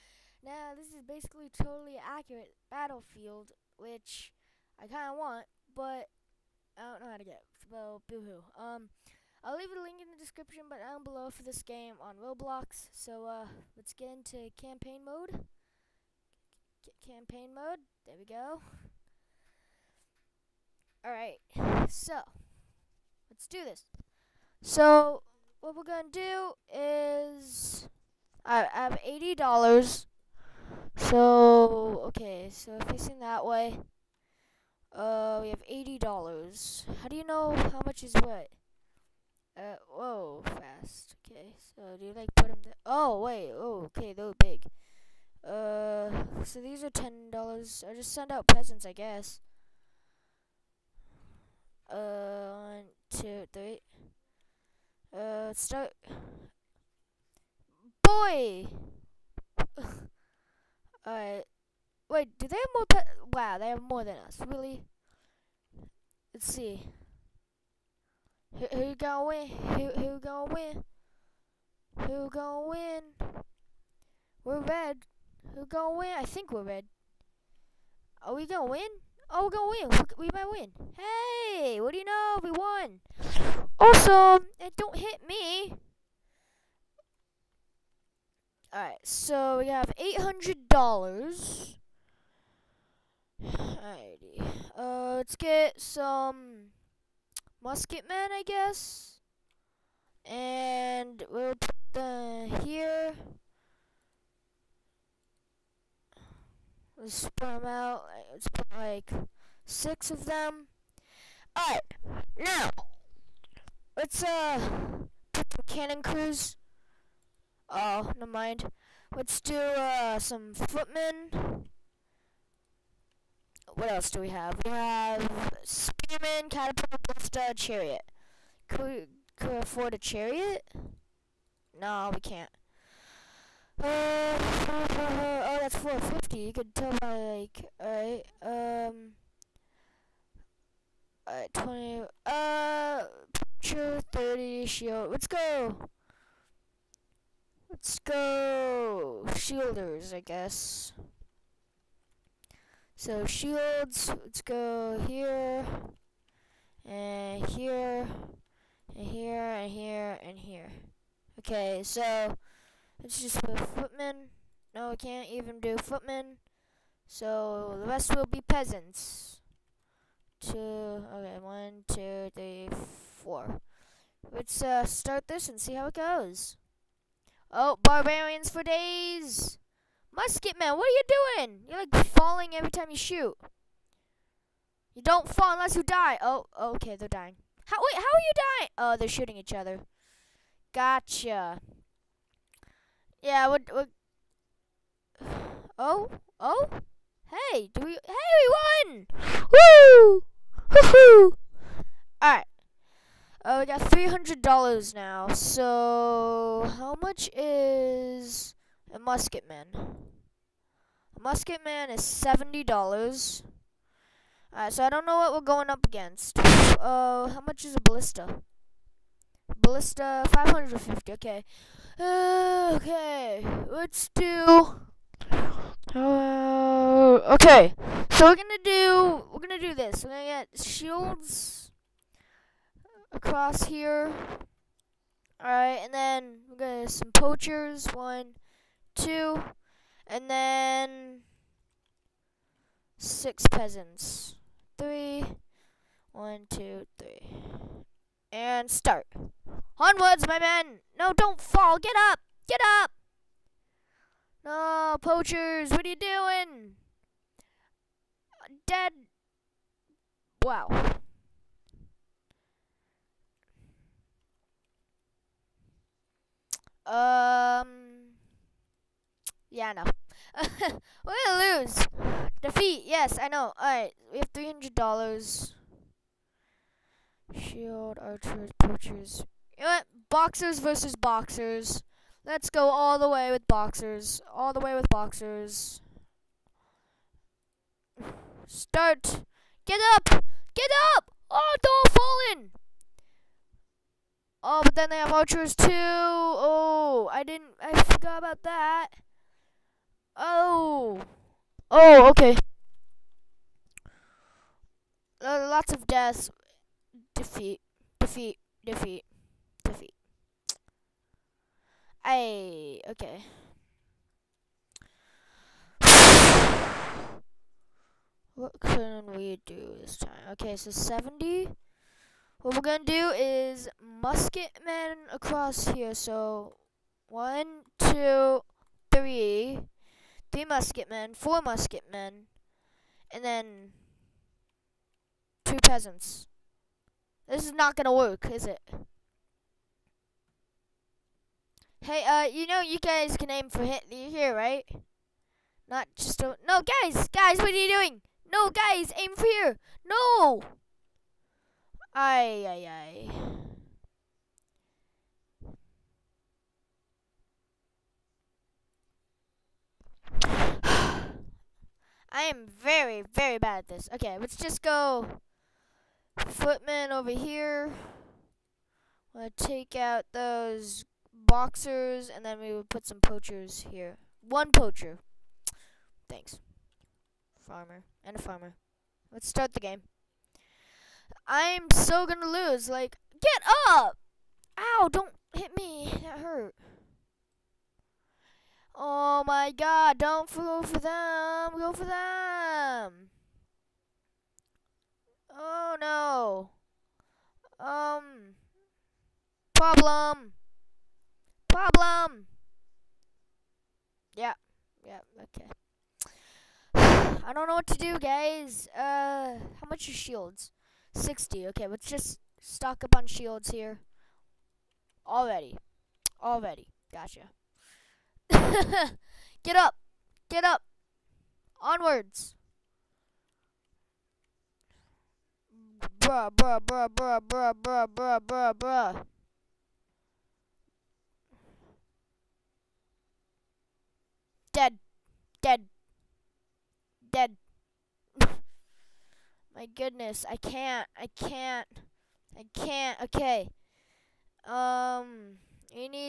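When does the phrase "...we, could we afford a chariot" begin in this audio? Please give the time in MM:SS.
02:08.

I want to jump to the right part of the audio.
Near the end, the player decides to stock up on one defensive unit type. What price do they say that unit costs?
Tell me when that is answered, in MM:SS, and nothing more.
06:50.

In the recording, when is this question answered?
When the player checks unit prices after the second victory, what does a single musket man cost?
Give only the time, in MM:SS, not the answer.
03:29.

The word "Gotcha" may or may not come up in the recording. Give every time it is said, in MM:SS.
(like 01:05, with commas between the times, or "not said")
03:10, 06:56.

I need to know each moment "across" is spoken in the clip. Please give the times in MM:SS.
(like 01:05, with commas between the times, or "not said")
03:53, 05:25.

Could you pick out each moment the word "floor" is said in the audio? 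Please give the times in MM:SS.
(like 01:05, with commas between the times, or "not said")
02:53.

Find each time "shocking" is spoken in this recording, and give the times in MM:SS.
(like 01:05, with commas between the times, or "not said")
not said.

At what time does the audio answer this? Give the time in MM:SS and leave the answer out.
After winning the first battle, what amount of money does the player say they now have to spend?
01:29.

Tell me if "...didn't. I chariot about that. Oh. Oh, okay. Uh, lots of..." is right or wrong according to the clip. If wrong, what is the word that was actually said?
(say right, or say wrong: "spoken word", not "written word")
wrong: "forgot", not "chariot".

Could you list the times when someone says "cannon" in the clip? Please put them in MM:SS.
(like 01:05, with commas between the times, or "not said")
01:55.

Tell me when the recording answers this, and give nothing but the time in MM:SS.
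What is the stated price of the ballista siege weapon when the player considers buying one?
03:39.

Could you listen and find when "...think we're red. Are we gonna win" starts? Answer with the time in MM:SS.
01:16.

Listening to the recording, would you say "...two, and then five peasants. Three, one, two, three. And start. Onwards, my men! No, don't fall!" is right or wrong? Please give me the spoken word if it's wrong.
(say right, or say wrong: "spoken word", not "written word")
wrong: "six", not "five".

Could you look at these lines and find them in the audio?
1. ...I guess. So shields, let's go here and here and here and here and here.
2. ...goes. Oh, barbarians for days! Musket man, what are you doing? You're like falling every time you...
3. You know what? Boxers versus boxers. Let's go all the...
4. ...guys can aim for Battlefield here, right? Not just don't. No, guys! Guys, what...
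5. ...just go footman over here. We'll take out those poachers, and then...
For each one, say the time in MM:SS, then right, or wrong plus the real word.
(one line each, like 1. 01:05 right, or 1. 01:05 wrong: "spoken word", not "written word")
1. 02:30 right
2. 02:55 right
3. 04:39 right
4. 05:42 wrong: "Hitler", not "Battlefield"
5. 06:04 wrong: "boxers", not "poachers".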